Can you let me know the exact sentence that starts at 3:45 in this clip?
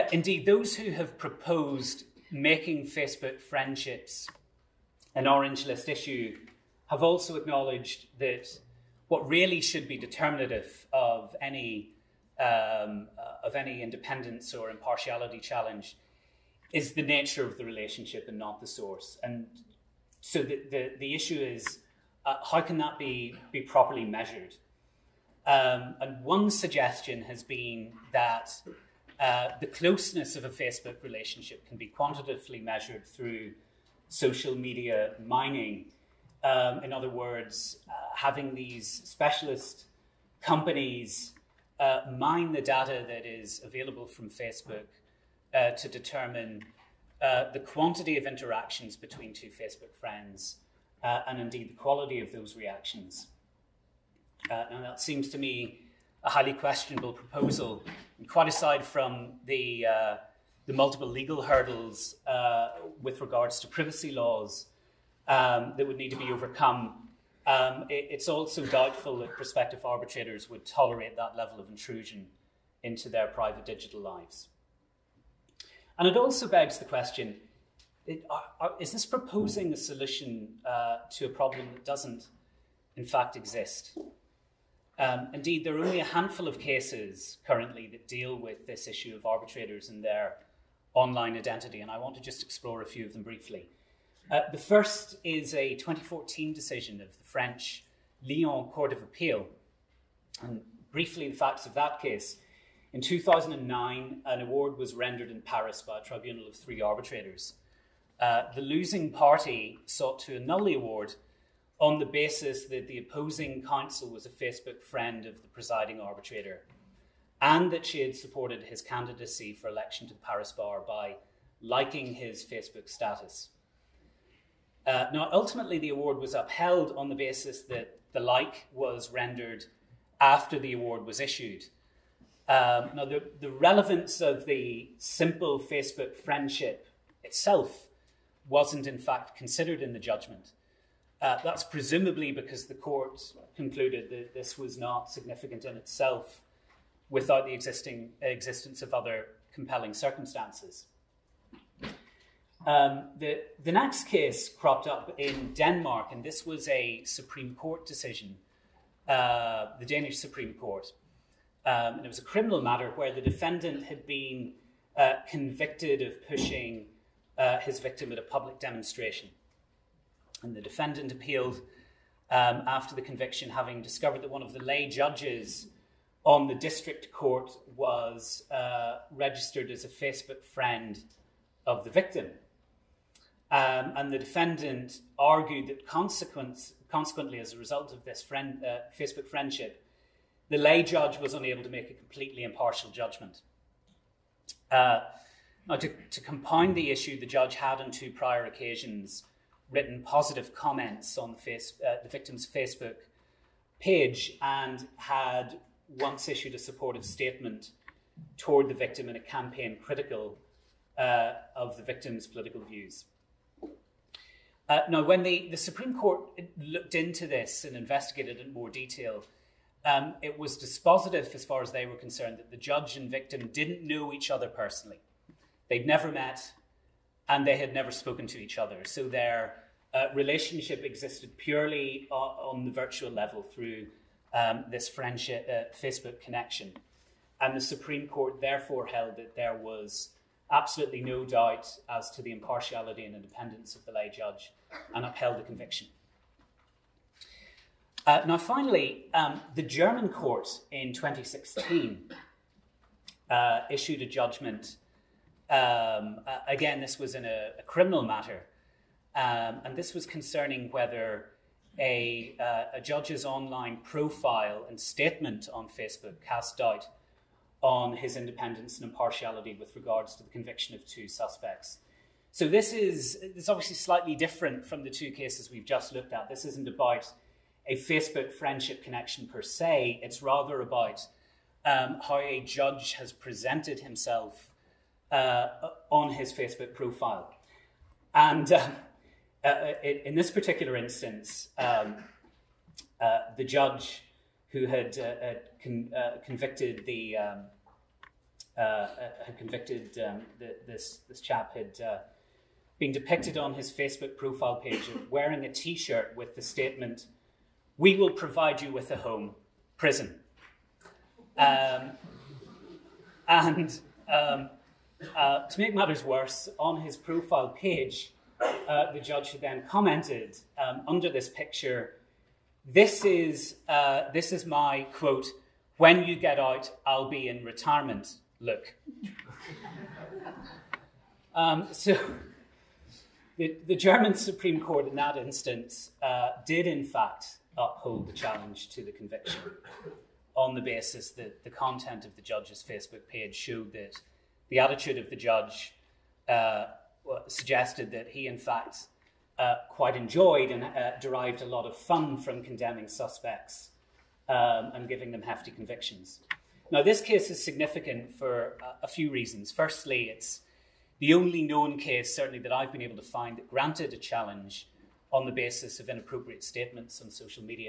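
They'd never met and they had never spoken to each other.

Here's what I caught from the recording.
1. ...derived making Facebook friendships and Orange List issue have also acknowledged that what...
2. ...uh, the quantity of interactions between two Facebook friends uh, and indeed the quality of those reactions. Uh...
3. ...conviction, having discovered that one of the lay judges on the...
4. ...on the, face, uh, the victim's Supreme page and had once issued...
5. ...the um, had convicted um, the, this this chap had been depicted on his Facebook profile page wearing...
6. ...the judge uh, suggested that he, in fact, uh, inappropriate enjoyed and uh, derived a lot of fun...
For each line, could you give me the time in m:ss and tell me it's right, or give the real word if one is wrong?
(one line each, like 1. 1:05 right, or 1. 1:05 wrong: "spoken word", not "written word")
1. 0:01 wrong: "proposed", not "derived"
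2. 0:47 right
3. 2:53 right
4. 3:21 wrong: "Facebook", not "Supreme"
5. 4:56 right
6. 5:45 wrong: "quite", not "inappropriate".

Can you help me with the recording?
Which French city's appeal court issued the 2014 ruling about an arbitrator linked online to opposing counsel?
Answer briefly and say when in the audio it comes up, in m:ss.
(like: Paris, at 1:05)
Lyon, at 1:38.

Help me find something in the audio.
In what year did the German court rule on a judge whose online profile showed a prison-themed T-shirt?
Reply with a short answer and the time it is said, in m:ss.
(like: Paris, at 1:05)
2016, at 4:10.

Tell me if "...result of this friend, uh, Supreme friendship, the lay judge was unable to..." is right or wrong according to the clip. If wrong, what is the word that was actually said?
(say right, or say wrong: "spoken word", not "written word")
wrong: "Facebook", not "Supreme".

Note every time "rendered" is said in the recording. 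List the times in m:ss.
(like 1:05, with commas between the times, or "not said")
1:44, 2:09.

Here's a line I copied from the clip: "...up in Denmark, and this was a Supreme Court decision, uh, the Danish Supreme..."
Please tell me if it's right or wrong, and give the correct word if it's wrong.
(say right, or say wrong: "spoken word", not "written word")
right.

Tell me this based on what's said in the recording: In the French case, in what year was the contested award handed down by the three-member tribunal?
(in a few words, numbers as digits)
2009.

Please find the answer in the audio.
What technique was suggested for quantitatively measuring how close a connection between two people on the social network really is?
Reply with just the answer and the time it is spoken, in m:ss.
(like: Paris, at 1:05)
Social media mining, at 0:34.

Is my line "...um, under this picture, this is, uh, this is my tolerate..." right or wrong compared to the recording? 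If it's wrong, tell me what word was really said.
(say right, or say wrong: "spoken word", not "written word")
wrong: "quote", not "tolerate".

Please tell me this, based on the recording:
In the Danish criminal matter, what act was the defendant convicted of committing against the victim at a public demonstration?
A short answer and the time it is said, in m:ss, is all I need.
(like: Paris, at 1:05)
Pushing, at 2:46.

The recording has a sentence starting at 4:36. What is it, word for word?
This isn't about a Facebook friendship connection per se.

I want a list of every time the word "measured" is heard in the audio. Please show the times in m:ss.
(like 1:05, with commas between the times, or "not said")
0:24, 0:32.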